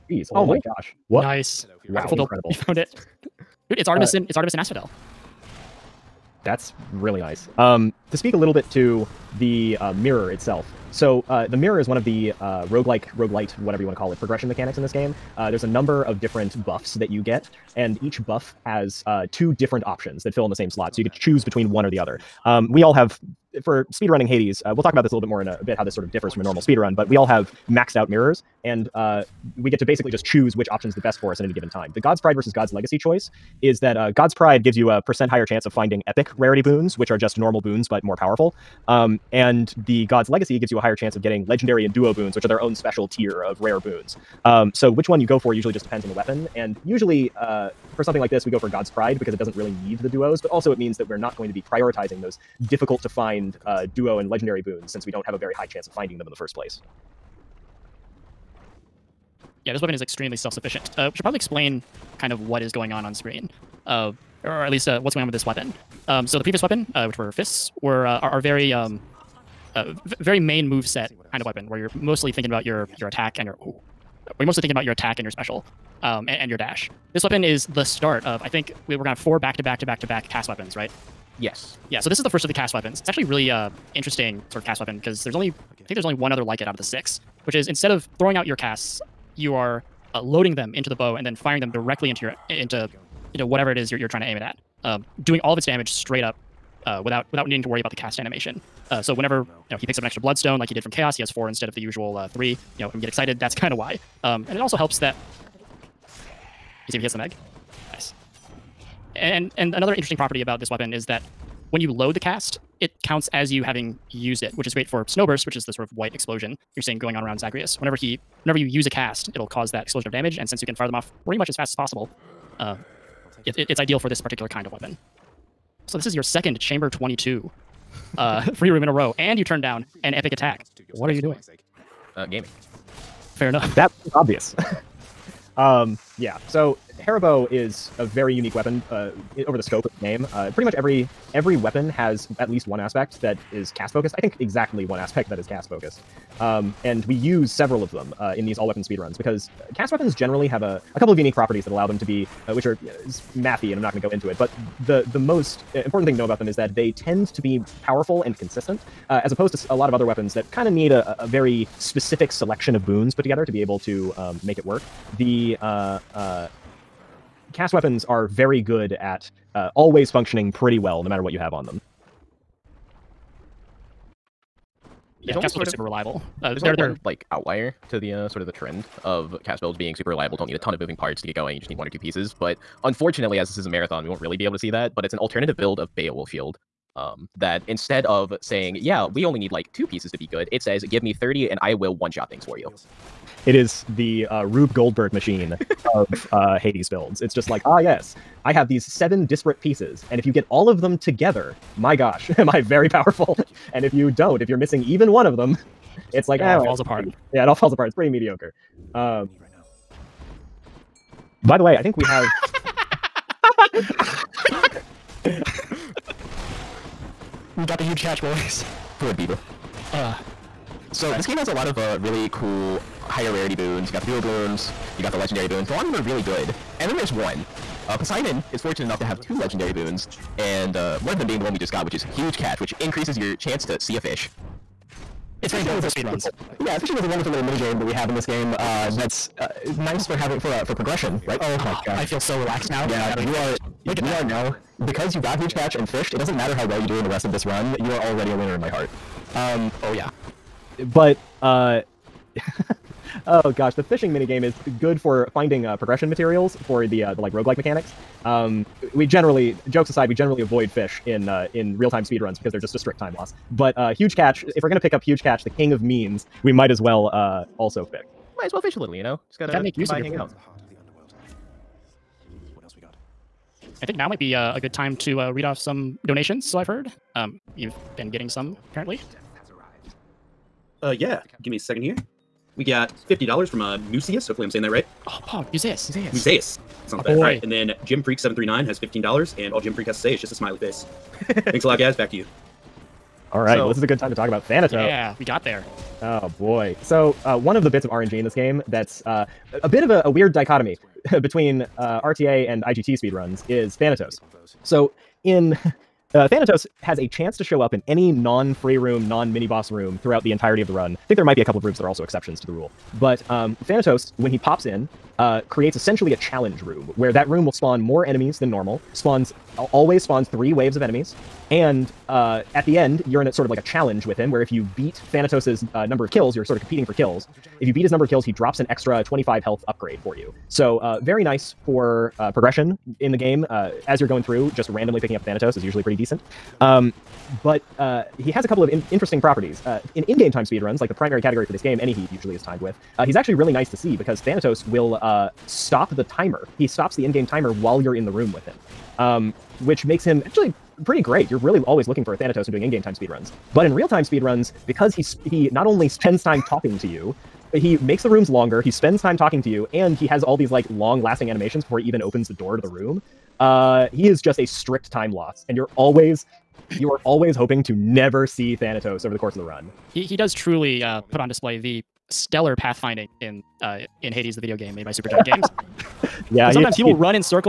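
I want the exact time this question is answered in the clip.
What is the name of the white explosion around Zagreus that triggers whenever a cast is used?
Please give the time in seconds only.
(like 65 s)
115 s.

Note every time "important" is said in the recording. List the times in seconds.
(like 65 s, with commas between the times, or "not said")
155 s, 235 s.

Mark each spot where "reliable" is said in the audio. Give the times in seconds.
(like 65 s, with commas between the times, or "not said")
175 s, 180 s.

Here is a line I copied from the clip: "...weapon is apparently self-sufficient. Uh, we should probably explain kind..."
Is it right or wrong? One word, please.
wrong.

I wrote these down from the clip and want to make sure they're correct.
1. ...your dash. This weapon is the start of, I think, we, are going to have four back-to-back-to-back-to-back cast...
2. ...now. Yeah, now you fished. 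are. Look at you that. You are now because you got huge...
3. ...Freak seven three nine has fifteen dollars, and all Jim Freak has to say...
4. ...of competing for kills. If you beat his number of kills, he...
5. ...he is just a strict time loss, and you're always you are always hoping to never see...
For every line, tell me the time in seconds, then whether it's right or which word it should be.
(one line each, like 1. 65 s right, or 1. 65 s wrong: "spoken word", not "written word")
1. 76 s right
2. 242 s right
3. 288 s right
4. 326 s right
5. 363 s right.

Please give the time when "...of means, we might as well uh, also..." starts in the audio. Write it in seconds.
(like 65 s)
265 s.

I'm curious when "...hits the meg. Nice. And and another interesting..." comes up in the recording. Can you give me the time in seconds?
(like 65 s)
107 s.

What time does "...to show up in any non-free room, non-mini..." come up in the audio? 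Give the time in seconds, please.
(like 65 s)
307 s.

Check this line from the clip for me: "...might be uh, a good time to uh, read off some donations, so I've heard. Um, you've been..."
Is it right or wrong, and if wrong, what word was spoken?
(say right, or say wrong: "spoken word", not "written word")
right.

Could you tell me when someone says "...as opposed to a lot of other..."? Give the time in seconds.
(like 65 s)
159 s.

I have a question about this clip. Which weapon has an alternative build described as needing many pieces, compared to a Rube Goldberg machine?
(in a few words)
Beowulf Shield.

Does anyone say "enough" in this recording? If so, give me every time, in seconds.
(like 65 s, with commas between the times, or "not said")
133 s, 228 s.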